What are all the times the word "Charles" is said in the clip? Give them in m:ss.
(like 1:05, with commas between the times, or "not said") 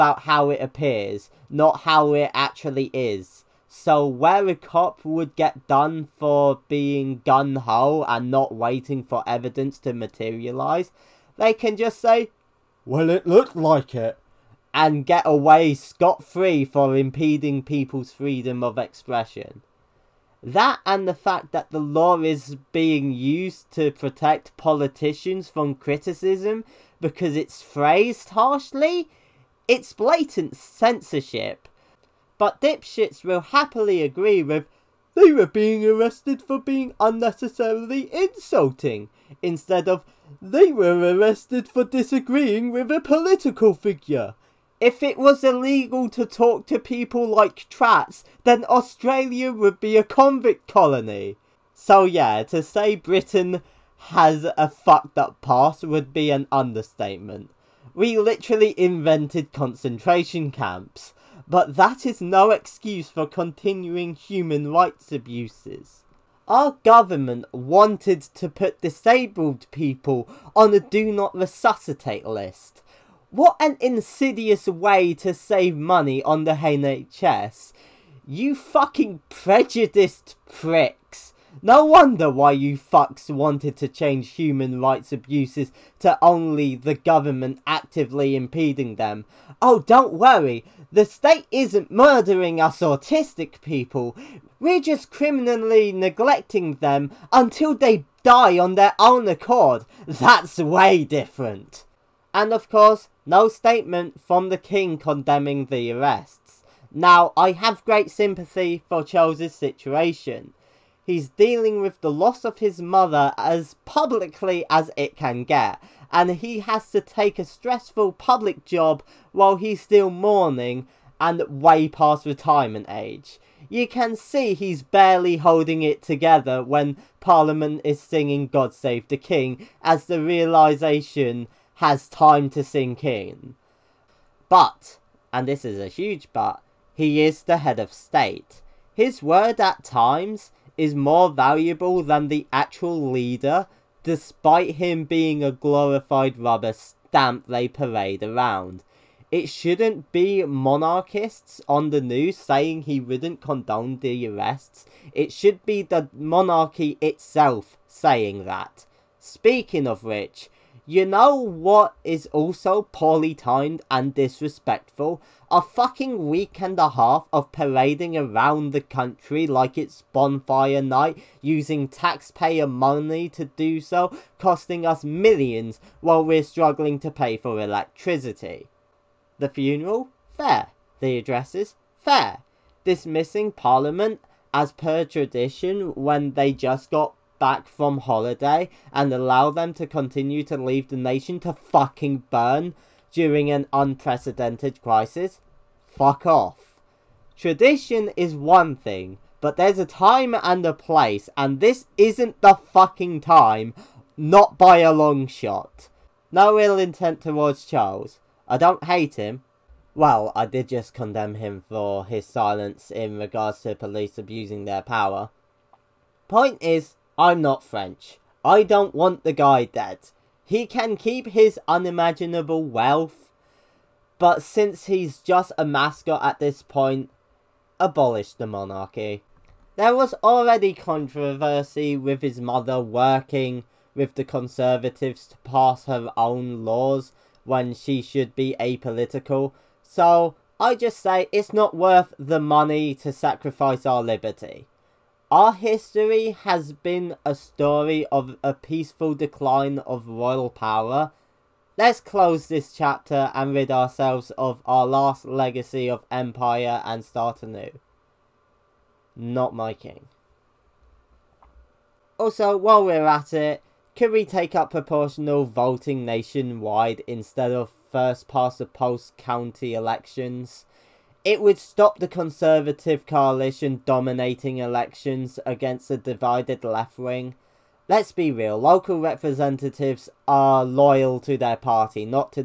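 1:49, 3:27.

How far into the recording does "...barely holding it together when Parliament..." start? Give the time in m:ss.
2:04.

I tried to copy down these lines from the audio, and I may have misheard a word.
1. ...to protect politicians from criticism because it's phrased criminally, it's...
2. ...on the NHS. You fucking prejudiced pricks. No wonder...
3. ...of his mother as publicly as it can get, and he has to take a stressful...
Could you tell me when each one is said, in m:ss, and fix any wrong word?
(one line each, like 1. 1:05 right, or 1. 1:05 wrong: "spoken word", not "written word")
1. 0:23 wrong: "harshly", not "criminally"
2. 1:16 right
3. 1:52 right.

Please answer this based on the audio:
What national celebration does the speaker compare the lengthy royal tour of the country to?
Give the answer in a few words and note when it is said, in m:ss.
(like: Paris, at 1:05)
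Bonfire night, at 2:50.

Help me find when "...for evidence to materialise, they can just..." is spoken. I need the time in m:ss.
0:09.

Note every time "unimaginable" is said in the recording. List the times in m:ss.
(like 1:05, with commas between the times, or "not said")
3:41.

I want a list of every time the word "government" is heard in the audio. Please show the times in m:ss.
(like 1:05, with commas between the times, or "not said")
1:06, 1:26.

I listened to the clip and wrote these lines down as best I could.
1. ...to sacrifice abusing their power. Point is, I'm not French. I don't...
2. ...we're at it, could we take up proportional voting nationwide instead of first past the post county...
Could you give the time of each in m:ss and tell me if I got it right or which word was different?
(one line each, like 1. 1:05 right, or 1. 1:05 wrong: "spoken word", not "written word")
1. 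3:33 wrong: "police", not "sacrifice"
2. 4:22 right.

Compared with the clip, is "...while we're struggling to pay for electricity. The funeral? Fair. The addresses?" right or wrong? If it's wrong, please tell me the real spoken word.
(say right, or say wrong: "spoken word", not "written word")
right.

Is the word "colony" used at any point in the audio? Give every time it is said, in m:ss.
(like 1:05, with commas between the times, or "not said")
0:50.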